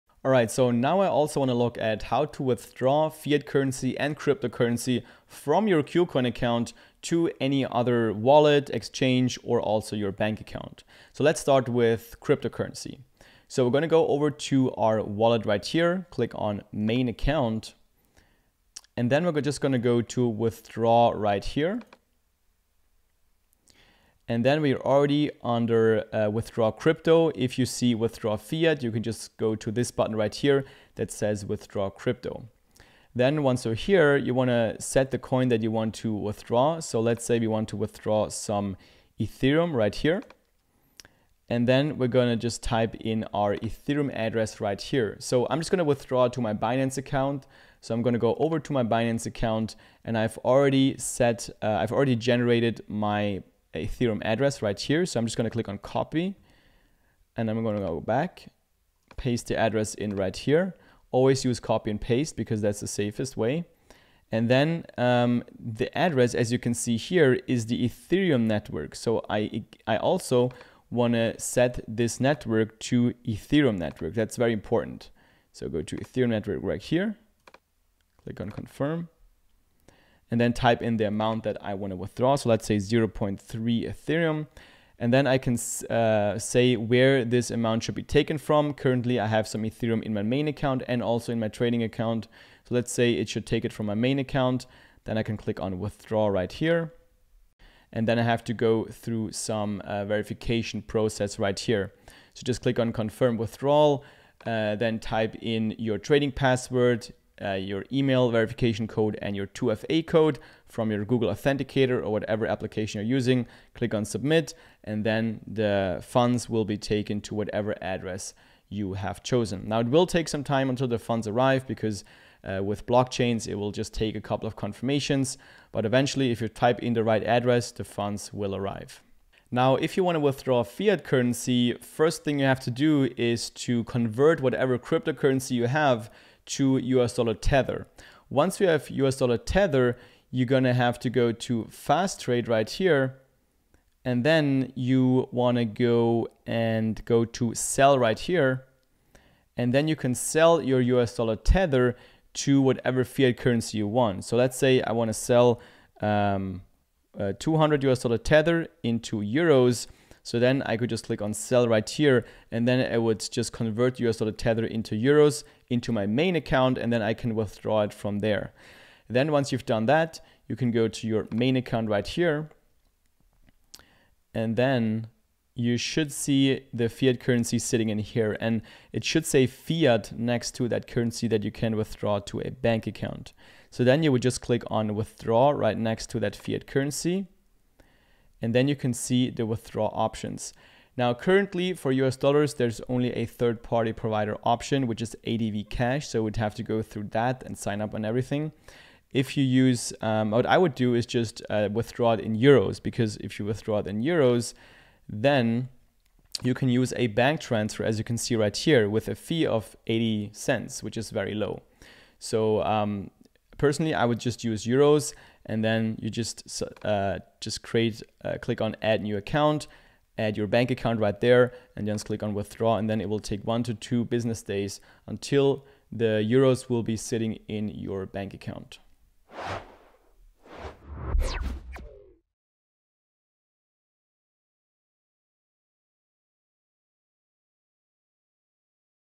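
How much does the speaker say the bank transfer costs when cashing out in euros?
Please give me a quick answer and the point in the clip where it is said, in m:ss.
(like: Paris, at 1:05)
80 cents, at 3:29.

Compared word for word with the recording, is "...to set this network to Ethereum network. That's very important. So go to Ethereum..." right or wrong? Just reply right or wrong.
right.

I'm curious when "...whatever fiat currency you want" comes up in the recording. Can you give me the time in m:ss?
2:32.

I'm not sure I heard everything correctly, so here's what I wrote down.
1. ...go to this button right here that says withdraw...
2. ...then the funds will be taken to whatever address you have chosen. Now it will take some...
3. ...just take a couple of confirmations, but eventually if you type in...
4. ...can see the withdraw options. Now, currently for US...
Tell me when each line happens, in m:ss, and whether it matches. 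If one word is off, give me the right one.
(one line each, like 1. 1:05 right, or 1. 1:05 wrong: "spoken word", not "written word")
1. 0:29 right
2. 1:55 right
3. 2:03 right
4. 3:08 right.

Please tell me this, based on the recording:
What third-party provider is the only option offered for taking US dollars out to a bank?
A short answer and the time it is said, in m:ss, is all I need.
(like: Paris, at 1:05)
ADV Cash, at 3:15.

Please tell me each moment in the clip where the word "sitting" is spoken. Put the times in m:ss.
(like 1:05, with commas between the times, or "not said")
2:57, 3:46.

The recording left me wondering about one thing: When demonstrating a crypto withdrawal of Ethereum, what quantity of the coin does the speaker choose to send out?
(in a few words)
0.3.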